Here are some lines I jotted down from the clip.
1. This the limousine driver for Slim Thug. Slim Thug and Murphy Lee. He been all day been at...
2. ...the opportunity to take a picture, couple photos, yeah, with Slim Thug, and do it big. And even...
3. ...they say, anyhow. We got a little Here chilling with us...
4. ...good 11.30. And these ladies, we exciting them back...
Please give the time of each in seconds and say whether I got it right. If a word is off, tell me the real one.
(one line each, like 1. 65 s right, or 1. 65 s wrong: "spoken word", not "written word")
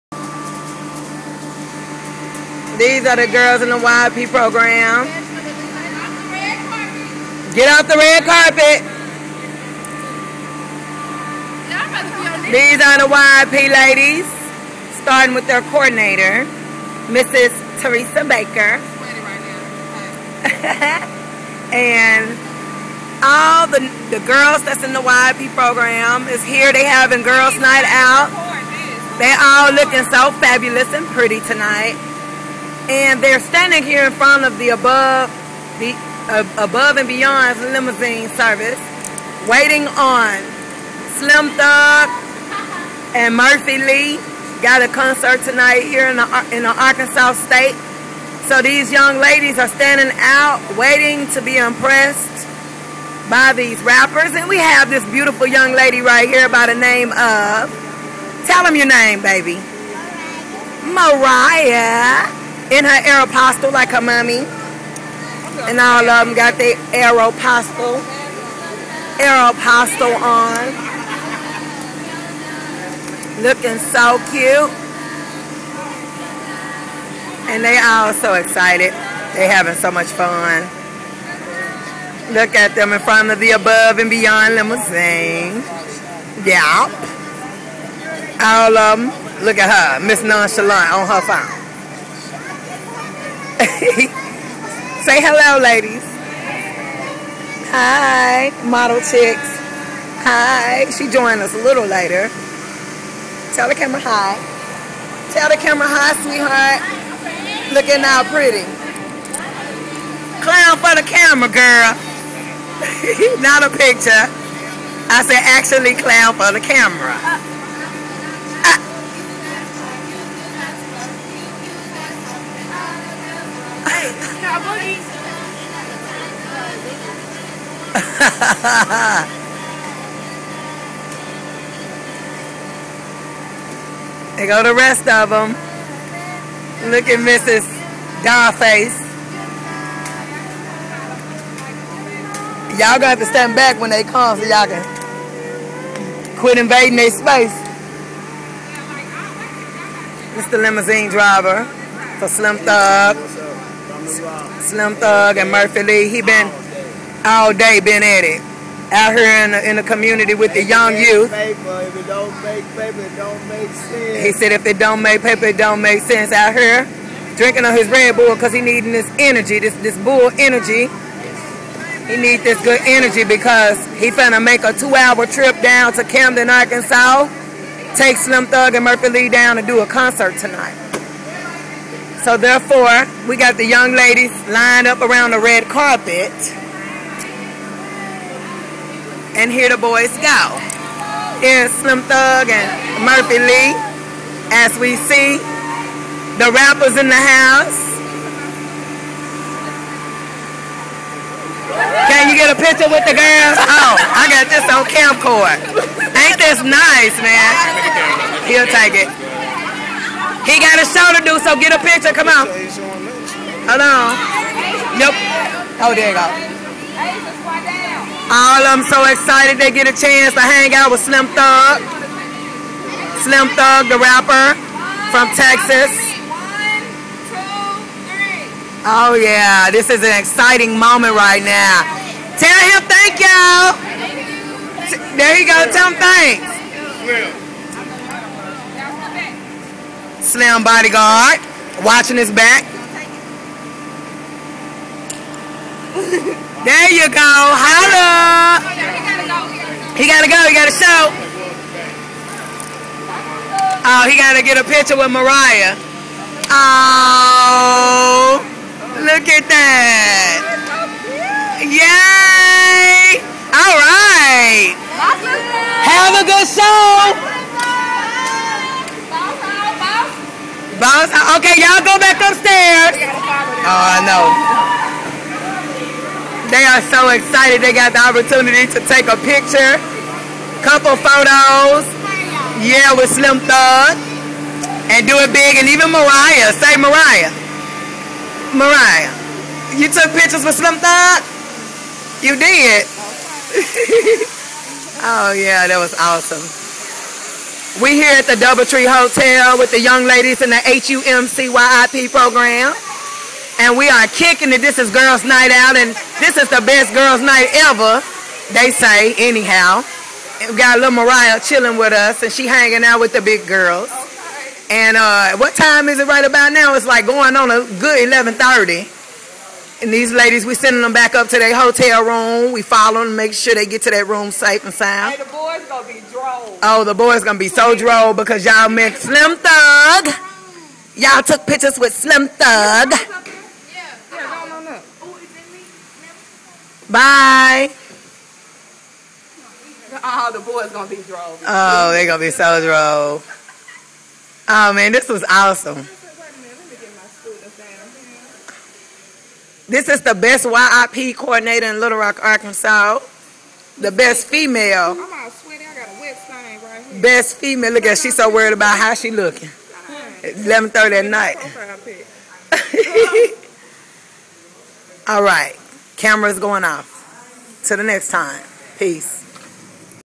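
1. 150 s right
2. 277 s right
3. 308 s wrong: "Mariah", not "Here"
4. 317 s wrong: "sending", not "exciting".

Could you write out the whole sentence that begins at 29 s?
They all looking so fabulous and pretty tonight.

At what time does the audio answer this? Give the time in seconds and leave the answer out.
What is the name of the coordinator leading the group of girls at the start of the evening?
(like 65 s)
17 s.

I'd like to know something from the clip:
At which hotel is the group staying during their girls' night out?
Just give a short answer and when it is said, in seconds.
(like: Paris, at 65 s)
Doubletree Hotel, at 298 s.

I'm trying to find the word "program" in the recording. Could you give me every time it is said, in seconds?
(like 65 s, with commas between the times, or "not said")
4 s, 25 s, 302 s.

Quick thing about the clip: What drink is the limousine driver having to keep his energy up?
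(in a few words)
Red Bull.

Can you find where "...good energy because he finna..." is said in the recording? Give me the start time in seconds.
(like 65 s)
172 s.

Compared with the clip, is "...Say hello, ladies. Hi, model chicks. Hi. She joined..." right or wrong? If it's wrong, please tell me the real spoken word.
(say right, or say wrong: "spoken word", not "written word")
right.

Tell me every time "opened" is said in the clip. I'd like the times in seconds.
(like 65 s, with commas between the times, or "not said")
not said.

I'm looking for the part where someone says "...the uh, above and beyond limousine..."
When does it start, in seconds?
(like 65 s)
35 s.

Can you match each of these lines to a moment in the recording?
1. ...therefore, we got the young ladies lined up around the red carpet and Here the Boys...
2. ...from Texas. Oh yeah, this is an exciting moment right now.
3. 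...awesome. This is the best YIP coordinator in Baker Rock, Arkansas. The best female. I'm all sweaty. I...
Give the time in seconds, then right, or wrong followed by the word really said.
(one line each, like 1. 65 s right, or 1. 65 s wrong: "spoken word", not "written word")
1. 182 s right
2. 225 s right
3. 345 s wrong: "Little", not "Baker".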